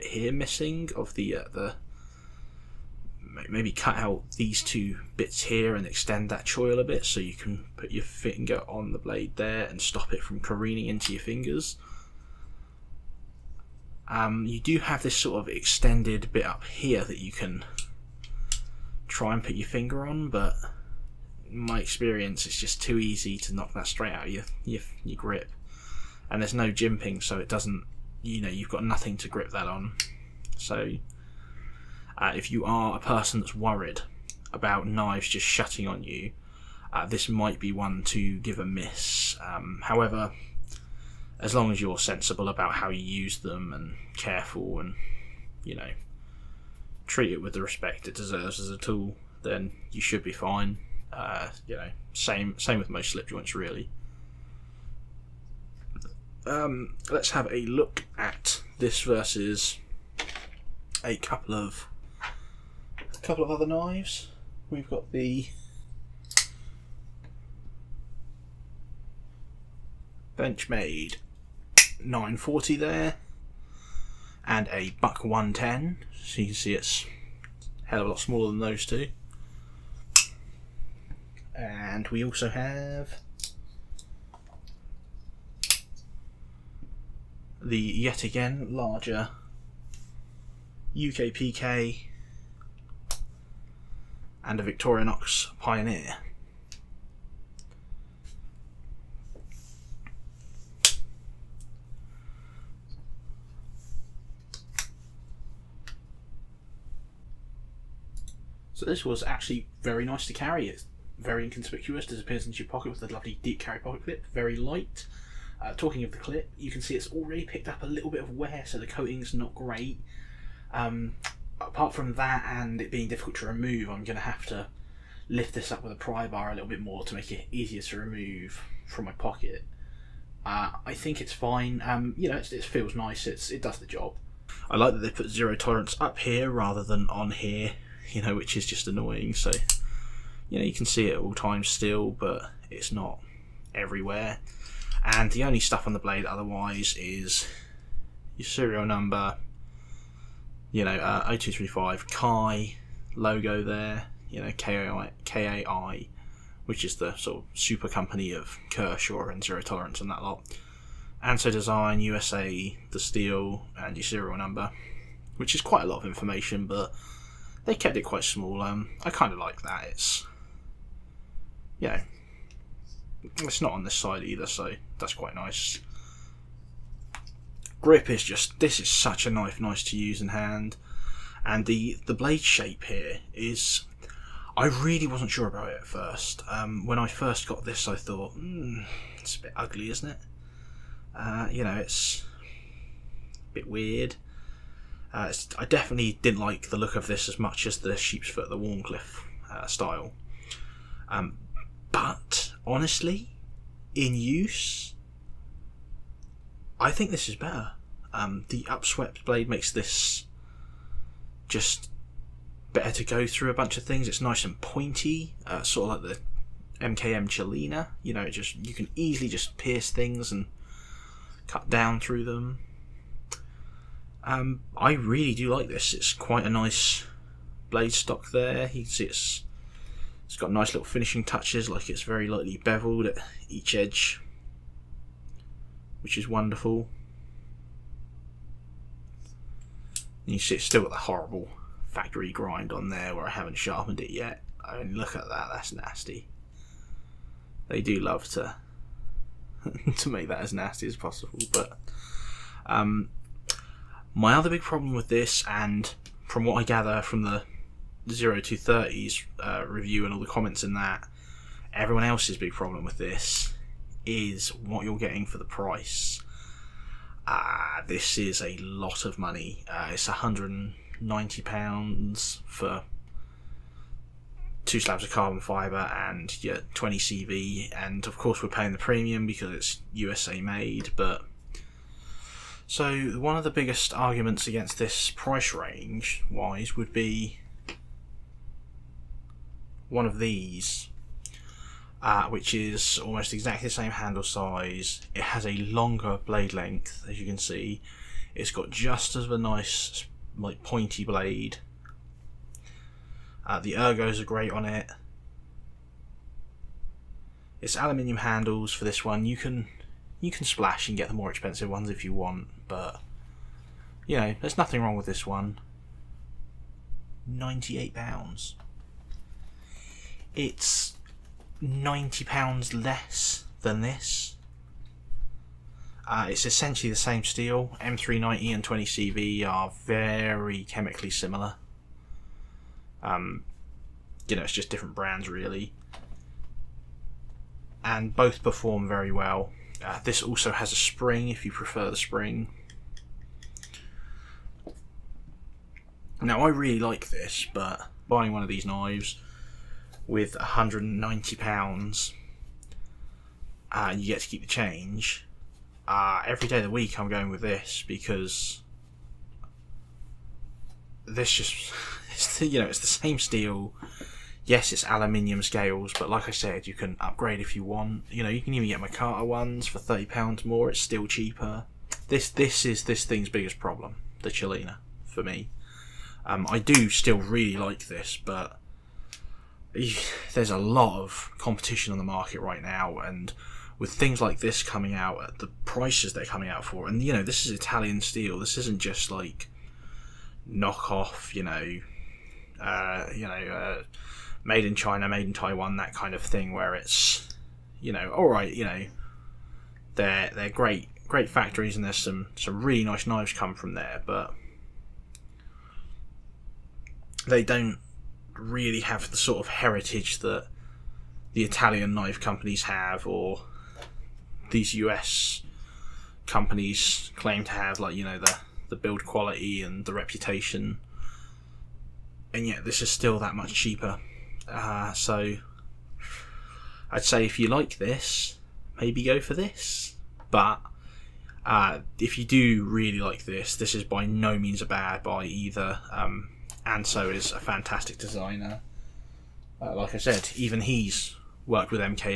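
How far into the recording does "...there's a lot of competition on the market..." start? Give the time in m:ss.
6:20.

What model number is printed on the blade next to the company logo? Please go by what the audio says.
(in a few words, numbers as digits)
0235.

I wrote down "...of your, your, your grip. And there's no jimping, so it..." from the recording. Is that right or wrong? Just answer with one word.
right.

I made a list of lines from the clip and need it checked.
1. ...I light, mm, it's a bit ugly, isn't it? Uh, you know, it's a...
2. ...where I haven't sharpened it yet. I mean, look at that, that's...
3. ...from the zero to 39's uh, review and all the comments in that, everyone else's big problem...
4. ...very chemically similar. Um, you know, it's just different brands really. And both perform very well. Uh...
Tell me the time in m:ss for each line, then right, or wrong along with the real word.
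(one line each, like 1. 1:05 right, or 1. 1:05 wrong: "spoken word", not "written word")
1. 3:07 wrong: "thought", not "light"
2. 4:03 right
3. 4:17 wrong: "30", not "39"
4. 5:29 right.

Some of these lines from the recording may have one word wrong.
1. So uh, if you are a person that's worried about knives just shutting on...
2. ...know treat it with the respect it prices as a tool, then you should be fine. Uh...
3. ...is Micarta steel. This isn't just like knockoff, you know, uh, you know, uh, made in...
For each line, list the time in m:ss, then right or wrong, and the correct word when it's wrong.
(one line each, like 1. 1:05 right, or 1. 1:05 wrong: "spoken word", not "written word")
1. 0:30 right
2. 0:45 wrong: "deserves", not "prices"
3. 6:27 wrong: "Italian", not "Micarta".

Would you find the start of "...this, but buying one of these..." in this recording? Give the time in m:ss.
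5:47.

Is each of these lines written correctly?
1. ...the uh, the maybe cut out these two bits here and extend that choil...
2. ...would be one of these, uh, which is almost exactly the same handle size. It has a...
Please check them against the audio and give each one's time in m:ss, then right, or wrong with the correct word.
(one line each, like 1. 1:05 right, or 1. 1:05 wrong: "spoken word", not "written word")
1. 0:01 right
2. 4:46 right.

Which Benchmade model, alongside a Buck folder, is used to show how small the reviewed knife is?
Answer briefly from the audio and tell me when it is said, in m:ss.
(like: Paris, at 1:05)
940, at 1:10.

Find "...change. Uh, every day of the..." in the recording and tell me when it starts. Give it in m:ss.
5:54.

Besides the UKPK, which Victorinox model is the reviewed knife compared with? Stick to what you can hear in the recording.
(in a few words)
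Pioneer.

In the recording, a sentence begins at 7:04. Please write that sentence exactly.
Uh, so I'd say if you like this, maybe go for this.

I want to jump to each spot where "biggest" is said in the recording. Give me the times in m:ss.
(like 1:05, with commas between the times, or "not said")
4:43, 6:13.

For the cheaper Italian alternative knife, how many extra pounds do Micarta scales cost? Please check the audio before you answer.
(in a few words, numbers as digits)
£30.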